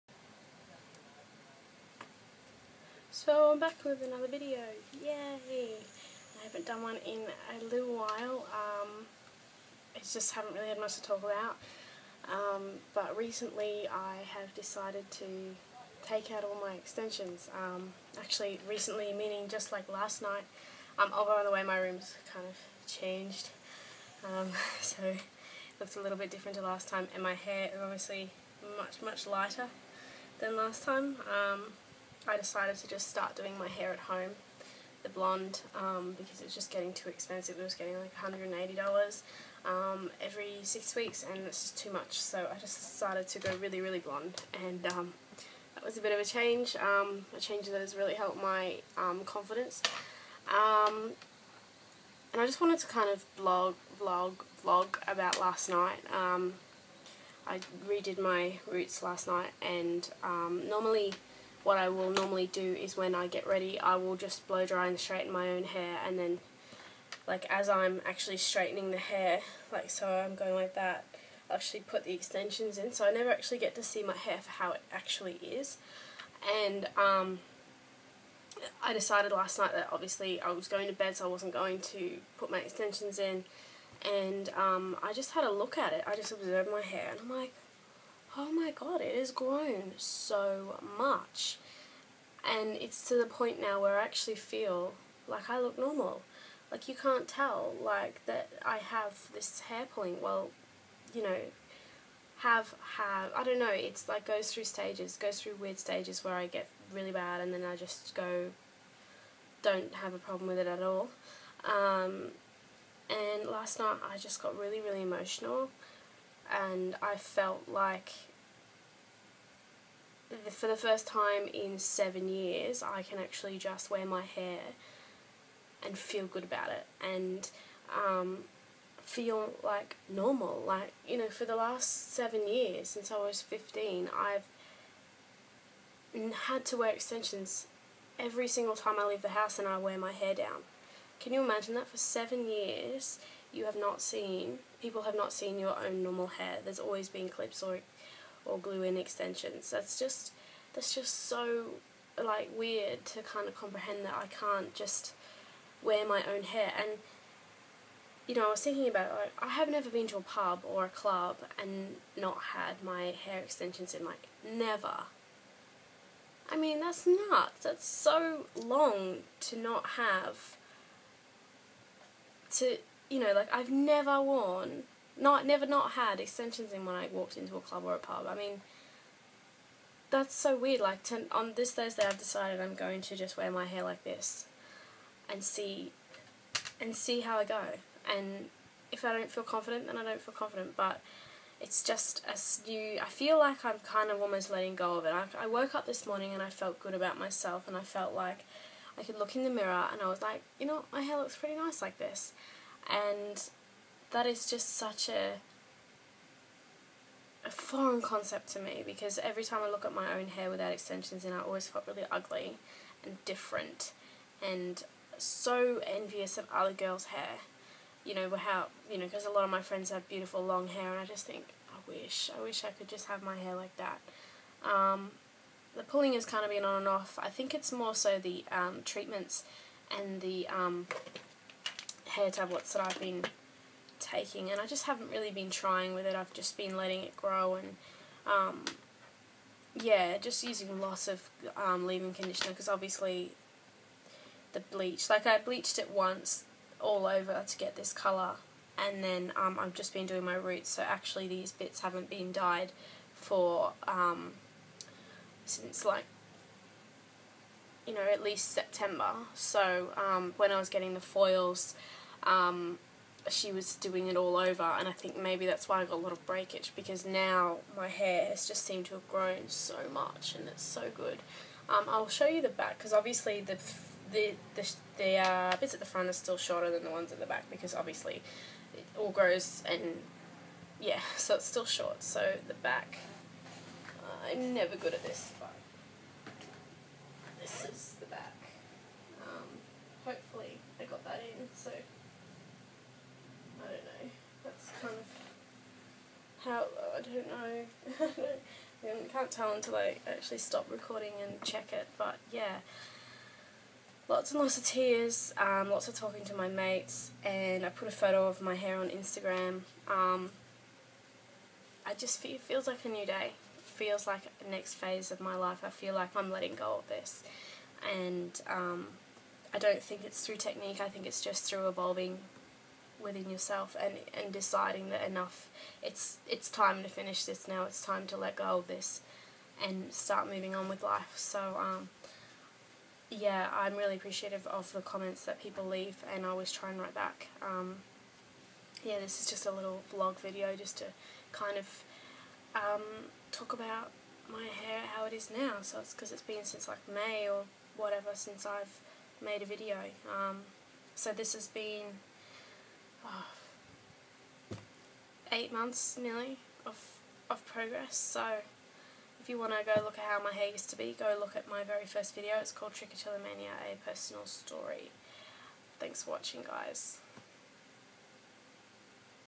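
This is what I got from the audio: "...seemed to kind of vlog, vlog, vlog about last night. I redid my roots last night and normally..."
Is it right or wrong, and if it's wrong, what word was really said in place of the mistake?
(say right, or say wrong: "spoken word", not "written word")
wrong: "wanted", not "seemed".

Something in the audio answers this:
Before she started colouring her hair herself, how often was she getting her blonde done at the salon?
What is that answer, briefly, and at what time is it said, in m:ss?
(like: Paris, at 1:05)
Every six weeks, at 0:40.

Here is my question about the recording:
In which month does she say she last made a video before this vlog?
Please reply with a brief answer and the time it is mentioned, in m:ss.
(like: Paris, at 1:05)
May, at 5:46.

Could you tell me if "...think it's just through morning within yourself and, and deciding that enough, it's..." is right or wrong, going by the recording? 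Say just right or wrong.
wrong.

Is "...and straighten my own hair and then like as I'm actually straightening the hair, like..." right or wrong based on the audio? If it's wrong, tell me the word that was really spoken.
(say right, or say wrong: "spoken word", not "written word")
right.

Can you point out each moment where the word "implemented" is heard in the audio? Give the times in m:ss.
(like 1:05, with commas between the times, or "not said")
not said.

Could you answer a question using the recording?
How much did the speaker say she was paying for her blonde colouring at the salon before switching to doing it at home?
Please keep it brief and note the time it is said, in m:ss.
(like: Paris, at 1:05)
$180, at 0:38.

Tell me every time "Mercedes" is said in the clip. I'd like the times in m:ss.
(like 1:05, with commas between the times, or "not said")
not said.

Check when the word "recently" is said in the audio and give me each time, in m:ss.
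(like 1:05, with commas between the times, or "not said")
0:13, 0:18.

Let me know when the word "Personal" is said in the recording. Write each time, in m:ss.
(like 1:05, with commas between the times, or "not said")
6:03.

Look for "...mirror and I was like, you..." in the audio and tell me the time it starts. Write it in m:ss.
3:19.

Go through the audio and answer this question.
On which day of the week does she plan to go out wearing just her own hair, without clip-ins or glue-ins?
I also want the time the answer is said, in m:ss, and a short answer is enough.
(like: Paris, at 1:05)
Thursday, at 3:01.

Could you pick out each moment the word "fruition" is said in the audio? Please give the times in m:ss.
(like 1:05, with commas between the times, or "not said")
not said.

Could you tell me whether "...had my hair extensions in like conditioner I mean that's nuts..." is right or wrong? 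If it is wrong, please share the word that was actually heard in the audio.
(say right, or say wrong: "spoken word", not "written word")
wrong: "never", not "conditioner".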